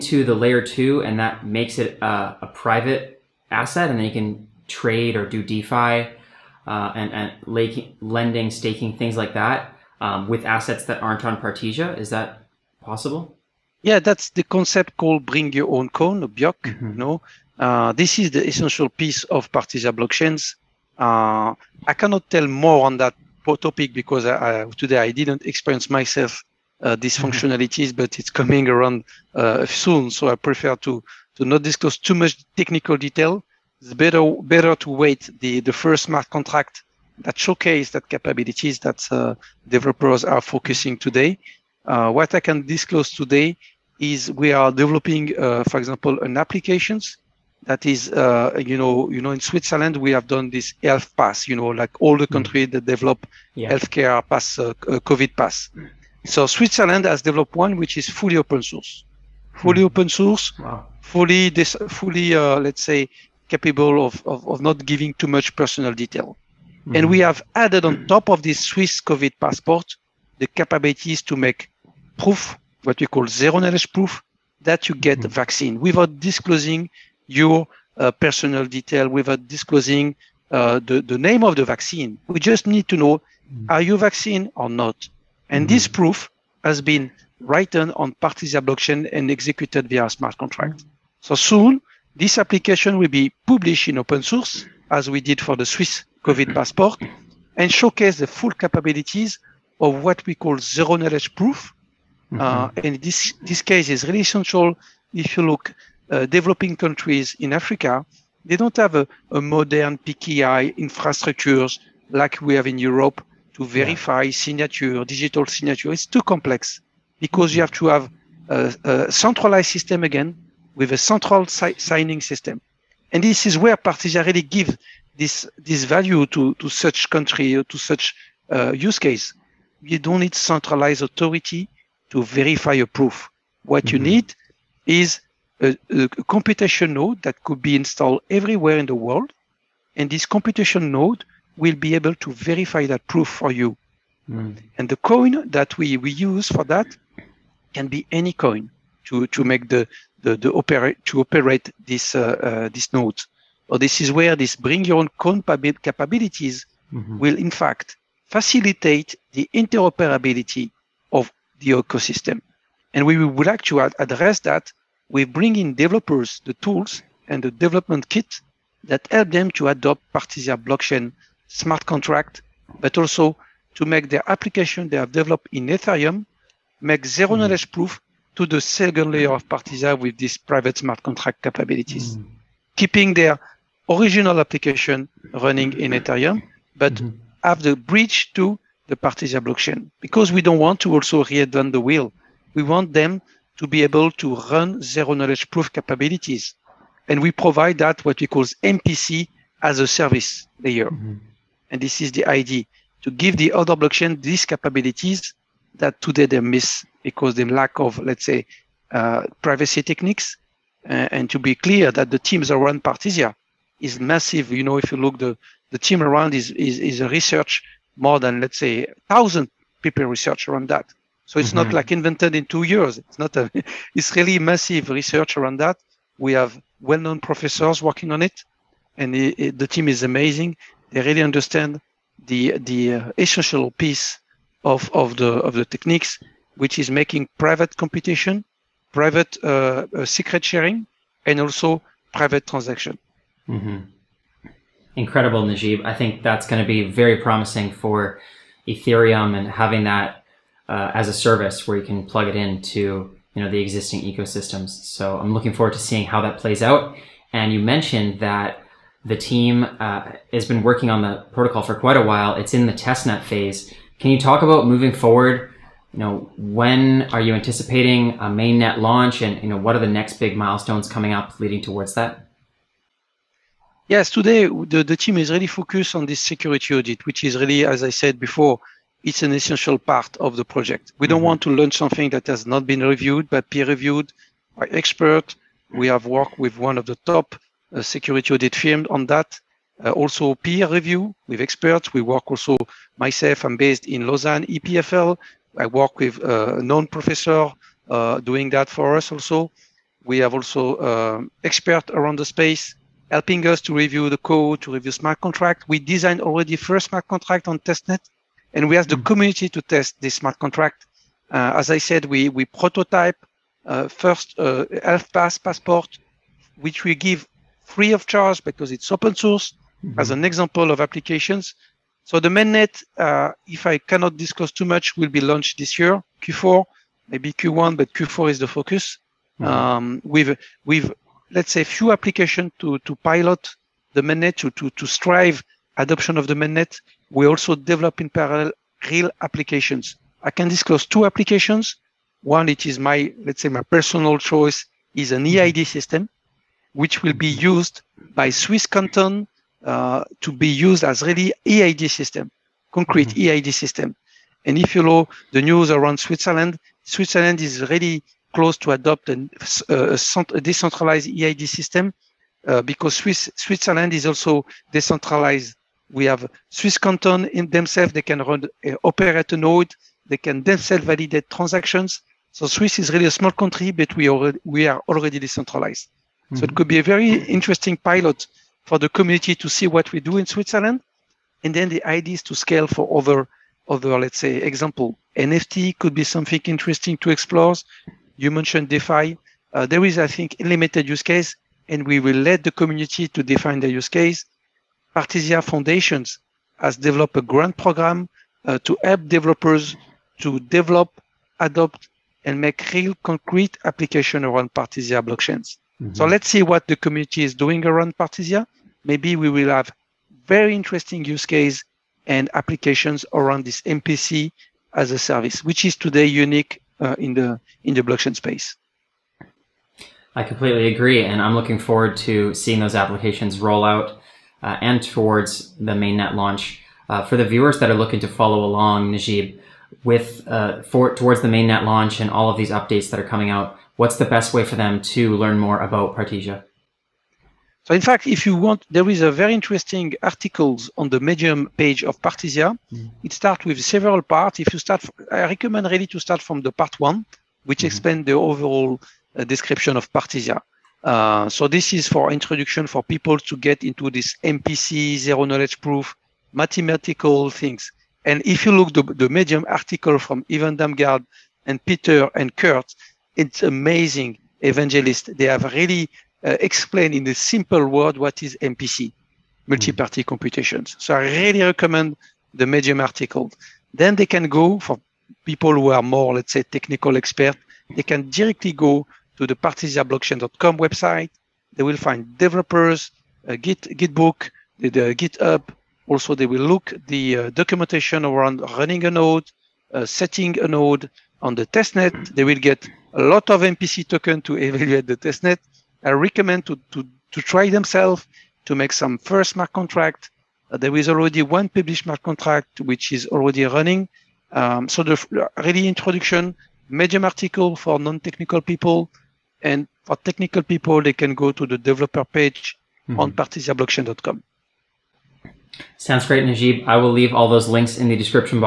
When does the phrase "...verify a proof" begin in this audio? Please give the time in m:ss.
2:12.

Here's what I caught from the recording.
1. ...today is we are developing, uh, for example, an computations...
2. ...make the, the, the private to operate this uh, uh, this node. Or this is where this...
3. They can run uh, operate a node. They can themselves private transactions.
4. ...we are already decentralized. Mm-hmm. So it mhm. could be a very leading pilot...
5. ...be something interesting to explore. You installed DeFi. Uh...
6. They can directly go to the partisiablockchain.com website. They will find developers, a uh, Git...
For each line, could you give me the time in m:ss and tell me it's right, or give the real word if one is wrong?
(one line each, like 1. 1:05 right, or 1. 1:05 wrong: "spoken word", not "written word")
1. 0:43 wrong: "applications", not "computations"
2. 2:29 wrong: "operate", not "private"
3. 6:07 wrong: "validate", not "private"
4. 6:14 wrong: "interesting", not "leading"
5. 6:25 wrong: "mentioned", not "installed"
6. 7:57 right.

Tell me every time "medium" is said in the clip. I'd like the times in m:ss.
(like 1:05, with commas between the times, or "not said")
7:20, 7:39, 7:52, 8:26.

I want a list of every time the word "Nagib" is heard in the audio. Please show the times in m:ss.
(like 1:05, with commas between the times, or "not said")
4:05, 7:08, 8:36.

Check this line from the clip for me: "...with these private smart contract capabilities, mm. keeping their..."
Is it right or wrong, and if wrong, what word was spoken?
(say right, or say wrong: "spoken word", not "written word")
right.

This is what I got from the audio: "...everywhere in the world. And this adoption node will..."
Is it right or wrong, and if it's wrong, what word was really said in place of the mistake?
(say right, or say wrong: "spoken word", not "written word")
wrong: "computation", not "adoption".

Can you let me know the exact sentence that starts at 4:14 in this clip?
So I'm looking forward to seeing how that plays out.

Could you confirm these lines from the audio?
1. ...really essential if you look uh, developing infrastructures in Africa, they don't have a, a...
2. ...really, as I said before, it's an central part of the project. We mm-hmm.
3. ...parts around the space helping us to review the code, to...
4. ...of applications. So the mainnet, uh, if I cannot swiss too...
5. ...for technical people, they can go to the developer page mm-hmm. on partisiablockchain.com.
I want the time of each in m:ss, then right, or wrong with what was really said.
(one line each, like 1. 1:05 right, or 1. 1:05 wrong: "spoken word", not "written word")
1. 1:44 wrong: "countries", not "infrastructures"
2. 4:37 wrong: "essential", not "central"
3. 5:01 wrong: "experts", not "parts"
4. 5:20 wrong: "discuss", not "swiss"
5. 8:29 right.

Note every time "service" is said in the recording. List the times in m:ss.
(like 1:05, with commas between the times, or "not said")
3:19, 4:11, 6:54.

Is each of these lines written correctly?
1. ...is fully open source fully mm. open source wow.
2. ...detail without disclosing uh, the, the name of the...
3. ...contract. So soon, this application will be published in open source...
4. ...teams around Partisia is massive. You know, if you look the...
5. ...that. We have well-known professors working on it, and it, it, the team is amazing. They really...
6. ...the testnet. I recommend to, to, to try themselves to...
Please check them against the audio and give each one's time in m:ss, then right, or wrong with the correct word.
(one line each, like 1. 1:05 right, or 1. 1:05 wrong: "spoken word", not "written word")
1. 0:57 right
2. 1:18 right
3. 1:30 right
4. 3:32 right
5. 3:45 right
6. 8:14 right.